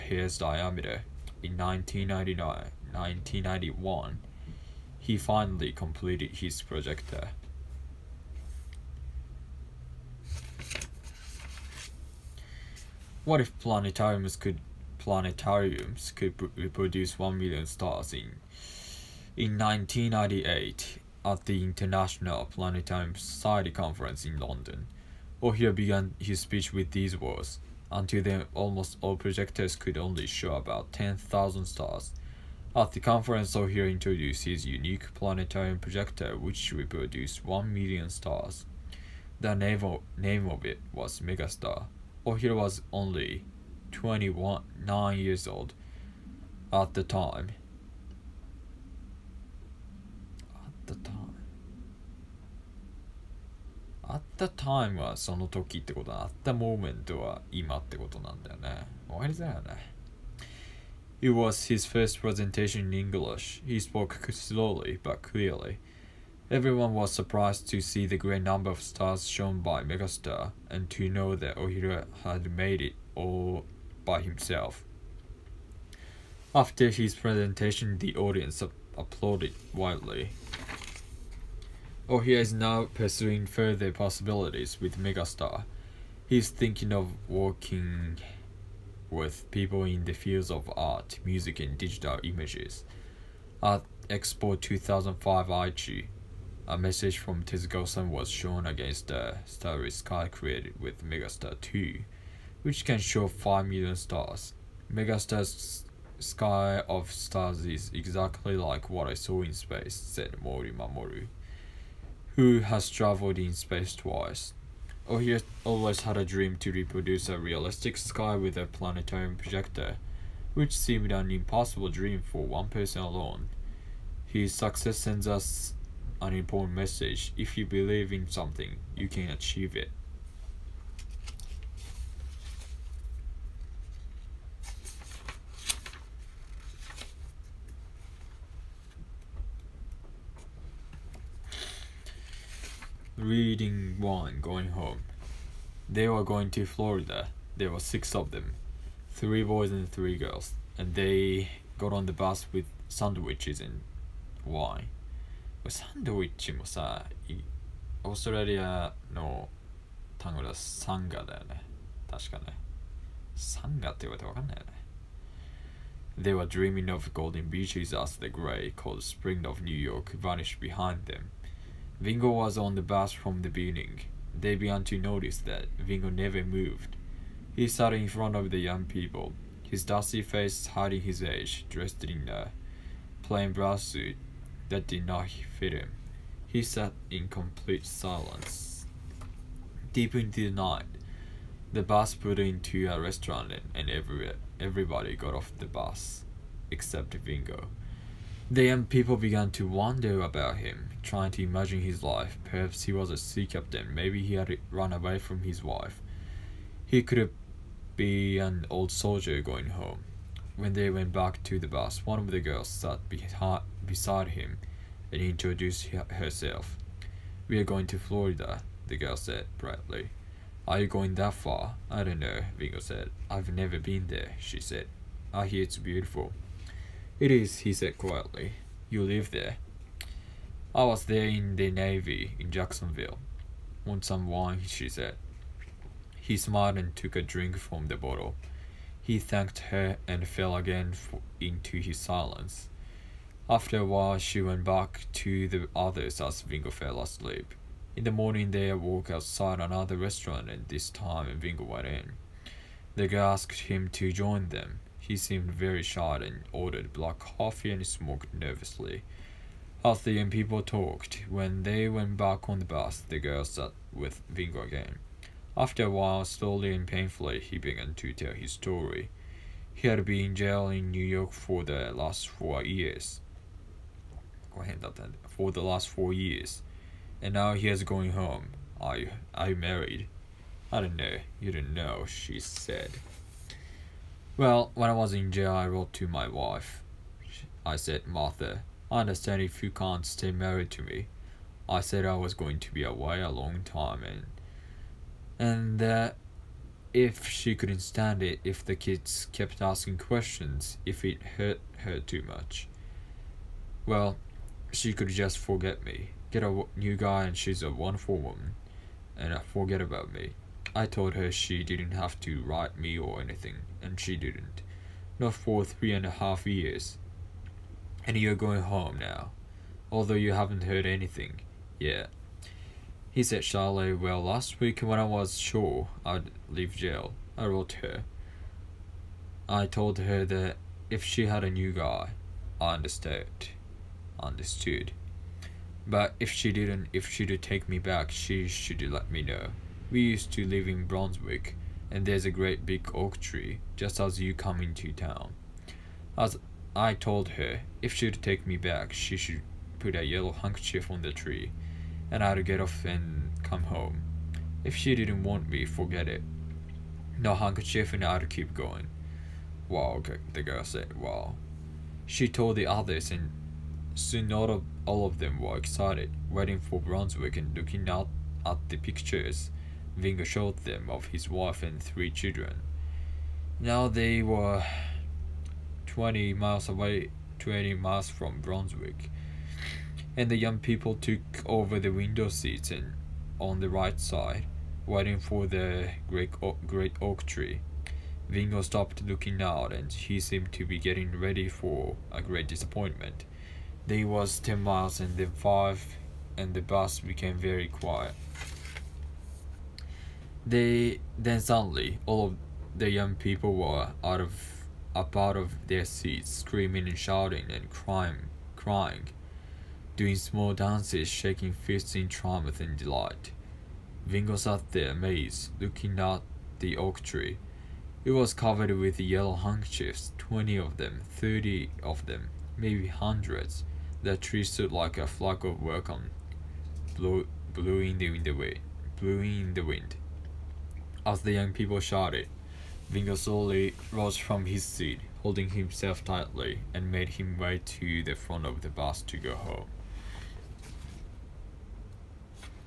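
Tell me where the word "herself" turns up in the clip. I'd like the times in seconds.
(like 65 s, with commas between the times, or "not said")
215 s.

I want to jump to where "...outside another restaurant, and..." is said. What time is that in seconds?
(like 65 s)
249 s.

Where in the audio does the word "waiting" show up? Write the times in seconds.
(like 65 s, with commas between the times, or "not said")
366 s, 384 s.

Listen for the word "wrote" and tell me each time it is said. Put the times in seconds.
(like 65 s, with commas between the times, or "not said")
285 s, 327 s.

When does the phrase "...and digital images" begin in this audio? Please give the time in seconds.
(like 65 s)
91 s.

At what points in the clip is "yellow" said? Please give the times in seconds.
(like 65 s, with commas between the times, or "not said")
350 s, 419 s.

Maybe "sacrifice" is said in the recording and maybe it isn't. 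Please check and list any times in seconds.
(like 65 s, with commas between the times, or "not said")
not said.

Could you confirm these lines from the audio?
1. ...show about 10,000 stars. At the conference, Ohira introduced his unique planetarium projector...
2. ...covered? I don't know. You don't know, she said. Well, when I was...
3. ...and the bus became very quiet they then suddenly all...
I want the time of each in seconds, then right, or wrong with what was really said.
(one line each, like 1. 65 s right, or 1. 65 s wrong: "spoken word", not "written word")
1. 30 s right
2. 279 s wrong: "married", not "covered"
3. 396 s right.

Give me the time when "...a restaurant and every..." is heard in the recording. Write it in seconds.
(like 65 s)
192 s.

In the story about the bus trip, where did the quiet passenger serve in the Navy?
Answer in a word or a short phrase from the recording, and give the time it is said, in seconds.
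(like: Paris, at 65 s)
Jacksonville, at 232 s.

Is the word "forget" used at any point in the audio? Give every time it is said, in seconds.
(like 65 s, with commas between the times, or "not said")
305 s, 309 s, 355 s.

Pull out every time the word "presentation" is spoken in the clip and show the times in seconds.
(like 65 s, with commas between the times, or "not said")
62 s, 77 s.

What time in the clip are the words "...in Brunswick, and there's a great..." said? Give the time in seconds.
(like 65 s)
340 s.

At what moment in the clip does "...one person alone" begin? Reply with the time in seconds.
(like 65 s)
122 s.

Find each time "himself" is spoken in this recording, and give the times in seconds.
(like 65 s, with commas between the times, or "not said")
74 s, 435 s.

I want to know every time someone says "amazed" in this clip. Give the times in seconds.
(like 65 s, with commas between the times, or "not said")
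414 s.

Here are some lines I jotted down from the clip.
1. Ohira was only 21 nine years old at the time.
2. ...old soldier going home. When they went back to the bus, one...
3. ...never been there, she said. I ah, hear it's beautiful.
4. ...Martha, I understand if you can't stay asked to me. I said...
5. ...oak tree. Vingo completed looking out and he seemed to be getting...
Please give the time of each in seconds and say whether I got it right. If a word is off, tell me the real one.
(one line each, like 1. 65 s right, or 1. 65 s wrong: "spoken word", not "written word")
1. 42 s right
2. 208 s right
3. 223 s right
4. 288 s wrong: "married", not "asked"
5. 387 s wrong: "stopped", not "completed".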